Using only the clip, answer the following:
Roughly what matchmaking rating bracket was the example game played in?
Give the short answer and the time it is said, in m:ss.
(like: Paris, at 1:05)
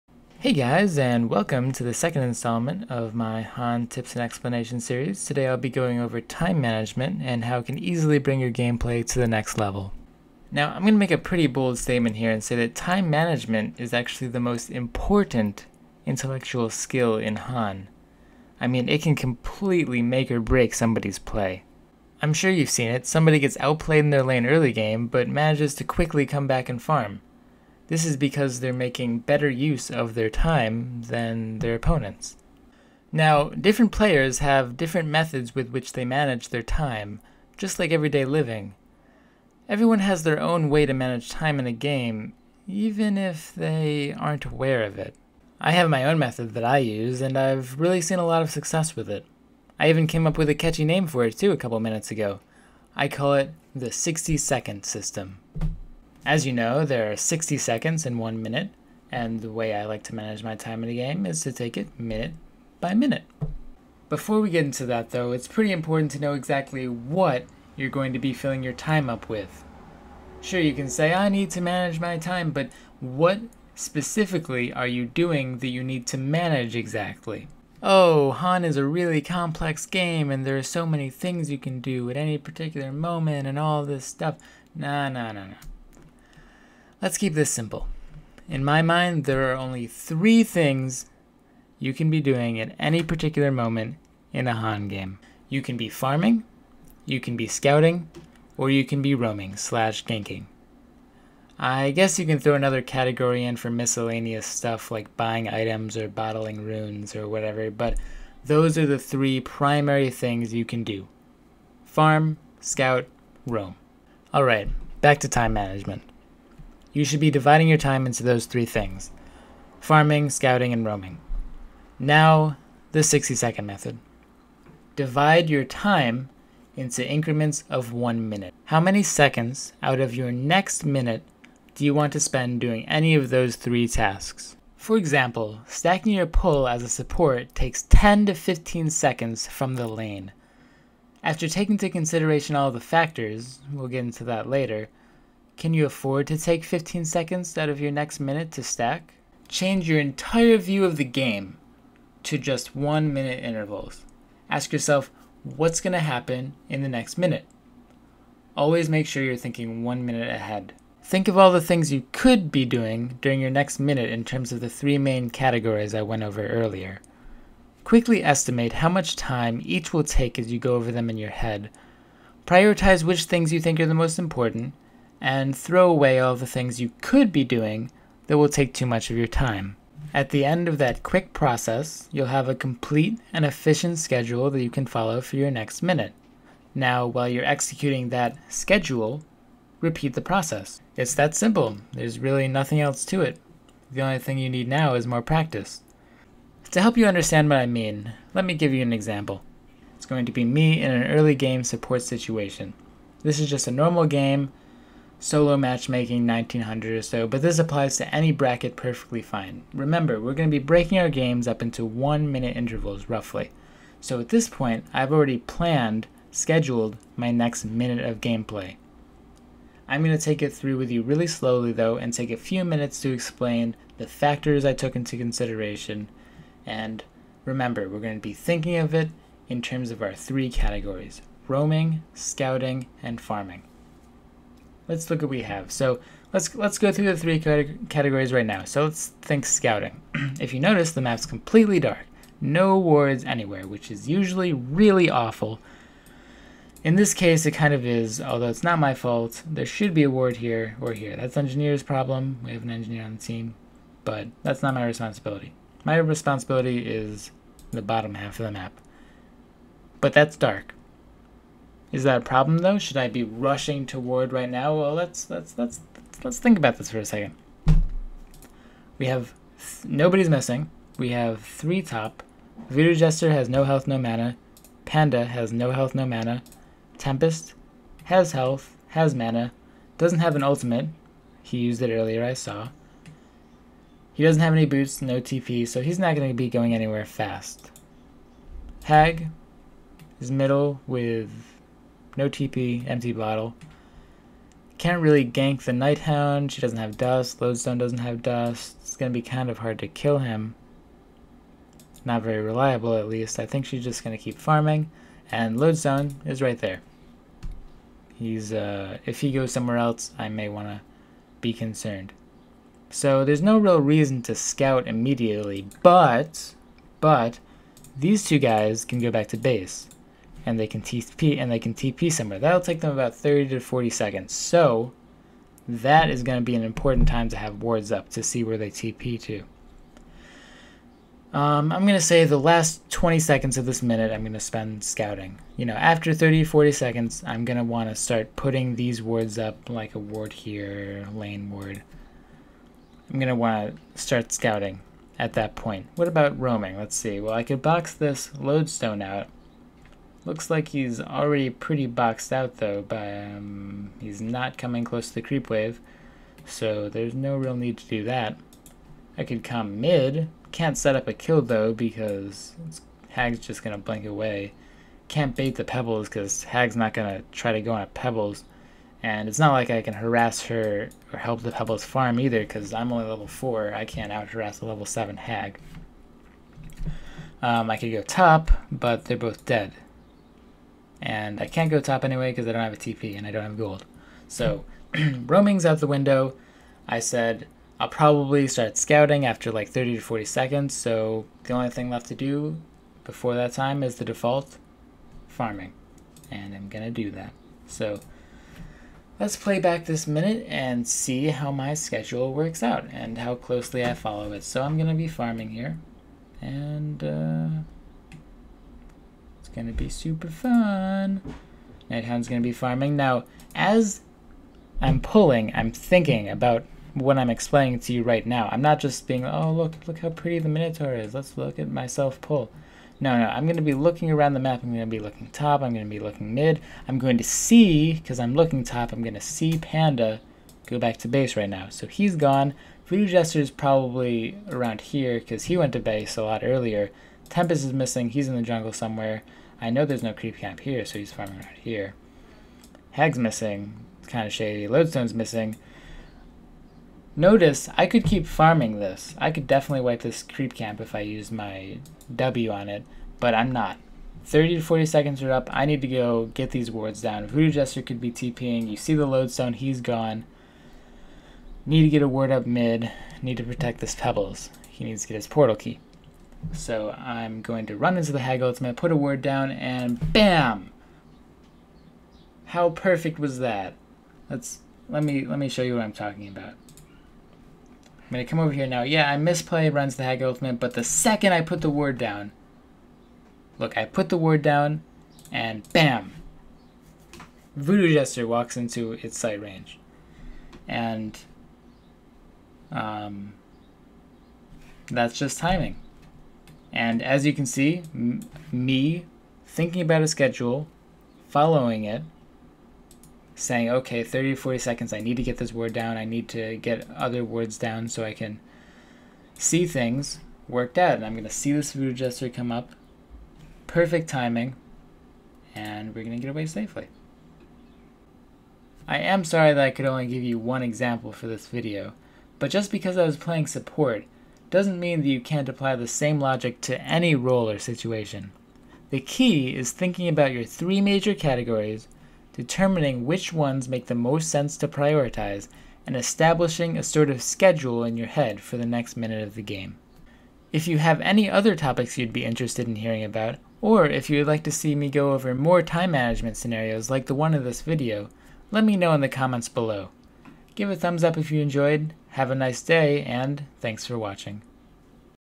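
1900, at 3:26.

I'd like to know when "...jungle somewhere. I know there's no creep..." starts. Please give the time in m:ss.
7:18.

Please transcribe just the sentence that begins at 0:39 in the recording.
Everyone has their own way to manage time in a game, even if they aren't aware of it.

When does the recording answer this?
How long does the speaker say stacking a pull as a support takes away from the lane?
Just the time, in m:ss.
2:17.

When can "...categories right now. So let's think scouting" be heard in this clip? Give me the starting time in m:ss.
3:57.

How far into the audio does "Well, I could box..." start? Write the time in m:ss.
5:47.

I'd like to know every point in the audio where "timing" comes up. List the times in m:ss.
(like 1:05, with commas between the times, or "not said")
8:15, 8:34.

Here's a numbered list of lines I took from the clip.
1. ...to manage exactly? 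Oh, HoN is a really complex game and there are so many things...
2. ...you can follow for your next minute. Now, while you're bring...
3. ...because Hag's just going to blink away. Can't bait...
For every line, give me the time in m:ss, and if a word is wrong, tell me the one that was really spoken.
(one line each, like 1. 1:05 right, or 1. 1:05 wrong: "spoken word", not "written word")
1. 1:16 right
2. 3:04 wrong: "executing", not "bring"
3. 6:01 right.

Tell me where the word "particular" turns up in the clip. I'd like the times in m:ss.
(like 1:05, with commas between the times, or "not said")
1:22, 1:33.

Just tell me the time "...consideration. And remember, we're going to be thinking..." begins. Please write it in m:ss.
3:45.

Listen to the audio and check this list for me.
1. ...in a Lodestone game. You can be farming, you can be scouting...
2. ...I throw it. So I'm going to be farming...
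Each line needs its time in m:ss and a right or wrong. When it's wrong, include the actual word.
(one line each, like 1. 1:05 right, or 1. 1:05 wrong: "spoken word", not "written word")
1. 1:34 wrong: "HoN", not "Lodestone"
2. 6:43 wrong: "follow", not "throw".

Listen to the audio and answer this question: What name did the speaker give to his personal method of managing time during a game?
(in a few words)
60 second system.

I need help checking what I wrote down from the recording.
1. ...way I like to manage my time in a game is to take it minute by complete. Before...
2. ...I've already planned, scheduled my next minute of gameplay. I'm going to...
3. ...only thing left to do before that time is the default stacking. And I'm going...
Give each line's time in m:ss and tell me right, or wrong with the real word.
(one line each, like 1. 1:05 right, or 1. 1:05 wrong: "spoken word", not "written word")
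1. 0:59 wrong: "minute", not "complete"
2. 3:34 right
3. 6:31 wrong: "farming", not "stacking".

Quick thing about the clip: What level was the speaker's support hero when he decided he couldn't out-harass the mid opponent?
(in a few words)
4.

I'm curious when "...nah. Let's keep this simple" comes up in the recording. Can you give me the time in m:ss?
1:25.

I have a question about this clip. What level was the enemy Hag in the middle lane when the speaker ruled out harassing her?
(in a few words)
7.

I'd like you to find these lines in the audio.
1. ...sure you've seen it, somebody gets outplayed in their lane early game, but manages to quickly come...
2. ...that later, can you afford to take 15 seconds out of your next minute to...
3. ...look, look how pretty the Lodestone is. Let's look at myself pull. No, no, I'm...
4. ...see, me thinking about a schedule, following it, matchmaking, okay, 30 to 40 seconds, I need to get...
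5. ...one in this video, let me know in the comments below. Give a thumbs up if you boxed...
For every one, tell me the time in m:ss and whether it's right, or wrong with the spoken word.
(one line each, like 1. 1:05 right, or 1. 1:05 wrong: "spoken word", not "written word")
1. 0:22 right
2. 2:24 right
3. 6:59 wrong: "Minotaur", not "Lodestone"
4. 8:17 wrong: "saying", not "matchmaking"
5. 9:07 wrong: "enjoyed", not "boxed".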